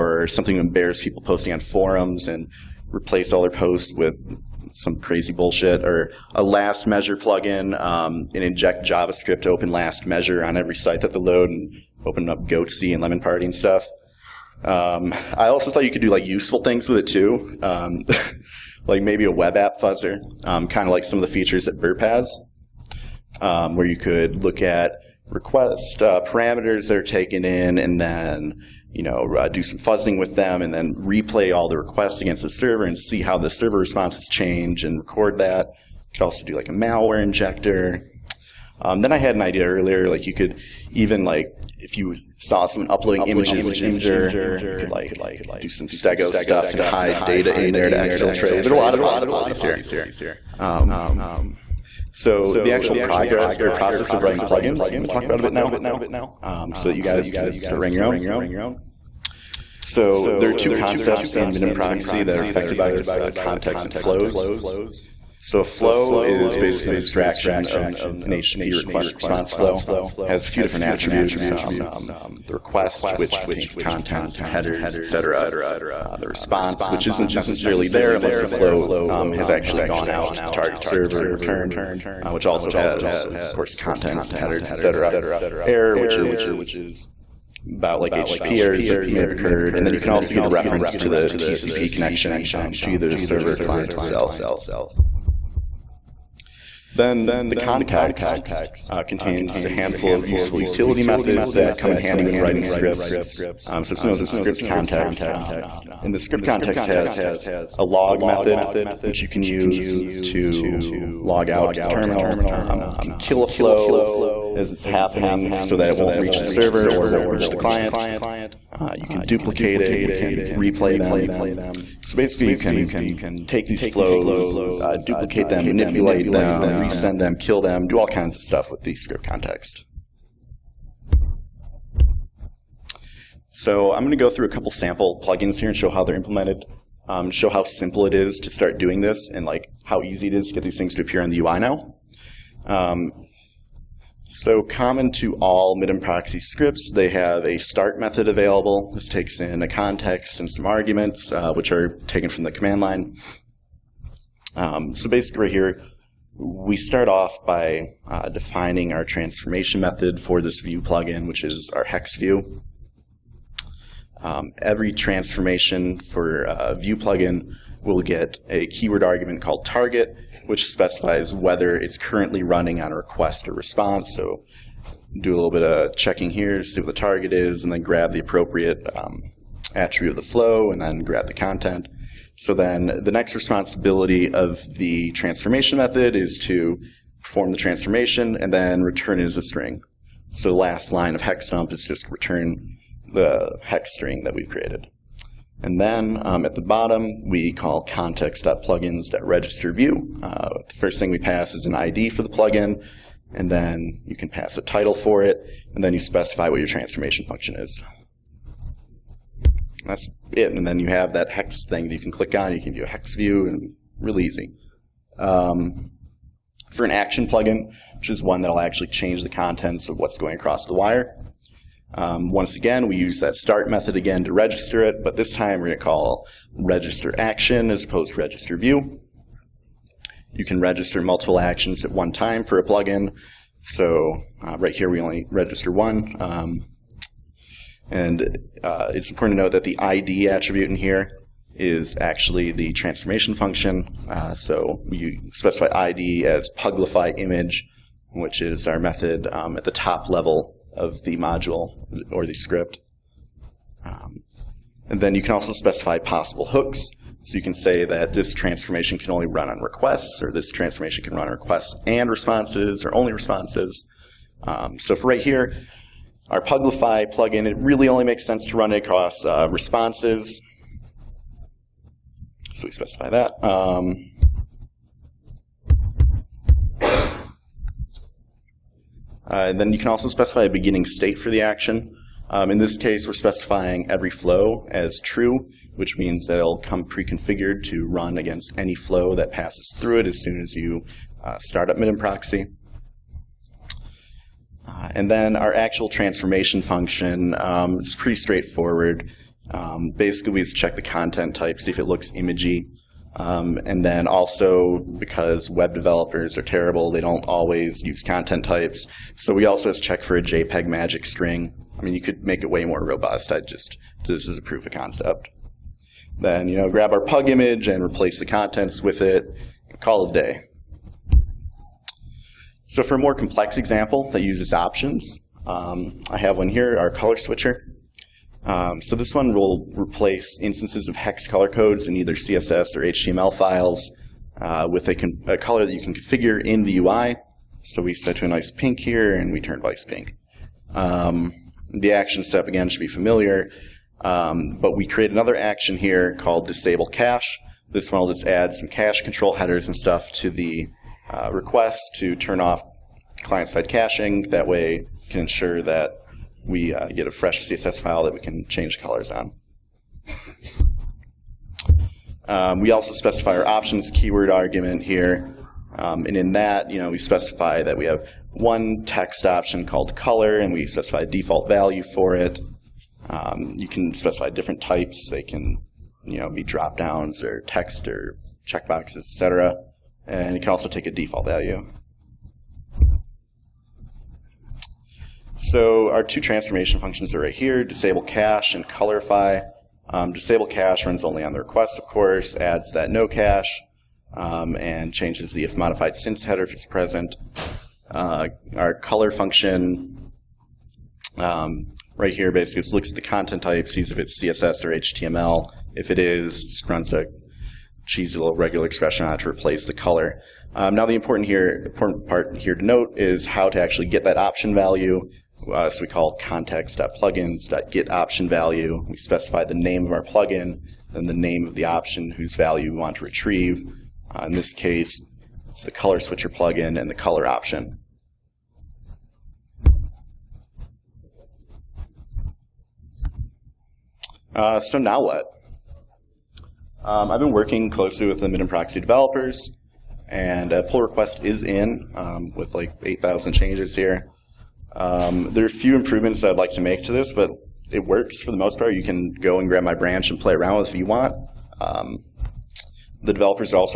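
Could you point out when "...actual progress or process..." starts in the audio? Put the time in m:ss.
0:52.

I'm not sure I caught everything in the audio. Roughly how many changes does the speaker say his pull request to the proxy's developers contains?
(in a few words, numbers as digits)
8,000.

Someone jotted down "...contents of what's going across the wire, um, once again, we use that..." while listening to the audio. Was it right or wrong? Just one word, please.
right.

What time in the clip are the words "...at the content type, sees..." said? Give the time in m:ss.
6:42.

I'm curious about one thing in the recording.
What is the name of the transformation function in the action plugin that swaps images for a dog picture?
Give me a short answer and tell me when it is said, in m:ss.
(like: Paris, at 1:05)
puglify image, at 4:06.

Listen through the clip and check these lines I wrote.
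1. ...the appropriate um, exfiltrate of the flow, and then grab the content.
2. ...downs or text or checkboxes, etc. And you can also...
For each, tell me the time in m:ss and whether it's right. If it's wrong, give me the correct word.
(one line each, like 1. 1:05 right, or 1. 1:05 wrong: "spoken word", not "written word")
1. 2:58 wrong: "attribute", not "exfiltrate"
2. 6:16 right.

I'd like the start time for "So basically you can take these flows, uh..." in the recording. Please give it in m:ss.
2:02.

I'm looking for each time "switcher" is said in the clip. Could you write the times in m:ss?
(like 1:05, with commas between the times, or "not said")
5:27, 7:05.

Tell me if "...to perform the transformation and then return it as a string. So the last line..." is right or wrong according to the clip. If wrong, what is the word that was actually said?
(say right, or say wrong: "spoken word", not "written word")
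right.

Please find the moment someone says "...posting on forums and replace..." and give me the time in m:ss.
0:01.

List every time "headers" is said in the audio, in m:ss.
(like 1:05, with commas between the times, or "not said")
1:14, 1:24, 5:49, 6:36.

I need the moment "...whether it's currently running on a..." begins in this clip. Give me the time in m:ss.
2:51.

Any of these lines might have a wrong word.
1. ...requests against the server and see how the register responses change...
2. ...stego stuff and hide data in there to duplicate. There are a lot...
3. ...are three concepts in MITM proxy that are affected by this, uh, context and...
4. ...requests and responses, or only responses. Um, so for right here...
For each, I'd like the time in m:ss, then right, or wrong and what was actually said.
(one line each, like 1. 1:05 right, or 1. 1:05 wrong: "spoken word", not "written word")
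1. 0:31 wrong: "server", not "register"
2. 0:45 wrong: "exfiltrate", not "duplicate"
3. 1:00 wrong: "two", not "three"
4. 4:21 right.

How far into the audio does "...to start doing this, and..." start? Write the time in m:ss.
2:18.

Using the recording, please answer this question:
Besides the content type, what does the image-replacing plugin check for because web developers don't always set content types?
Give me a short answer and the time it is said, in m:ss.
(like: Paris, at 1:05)
JPEG magic string, at 5:10.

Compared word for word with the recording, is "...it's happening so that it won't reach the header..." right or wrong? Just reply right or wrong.
wrong.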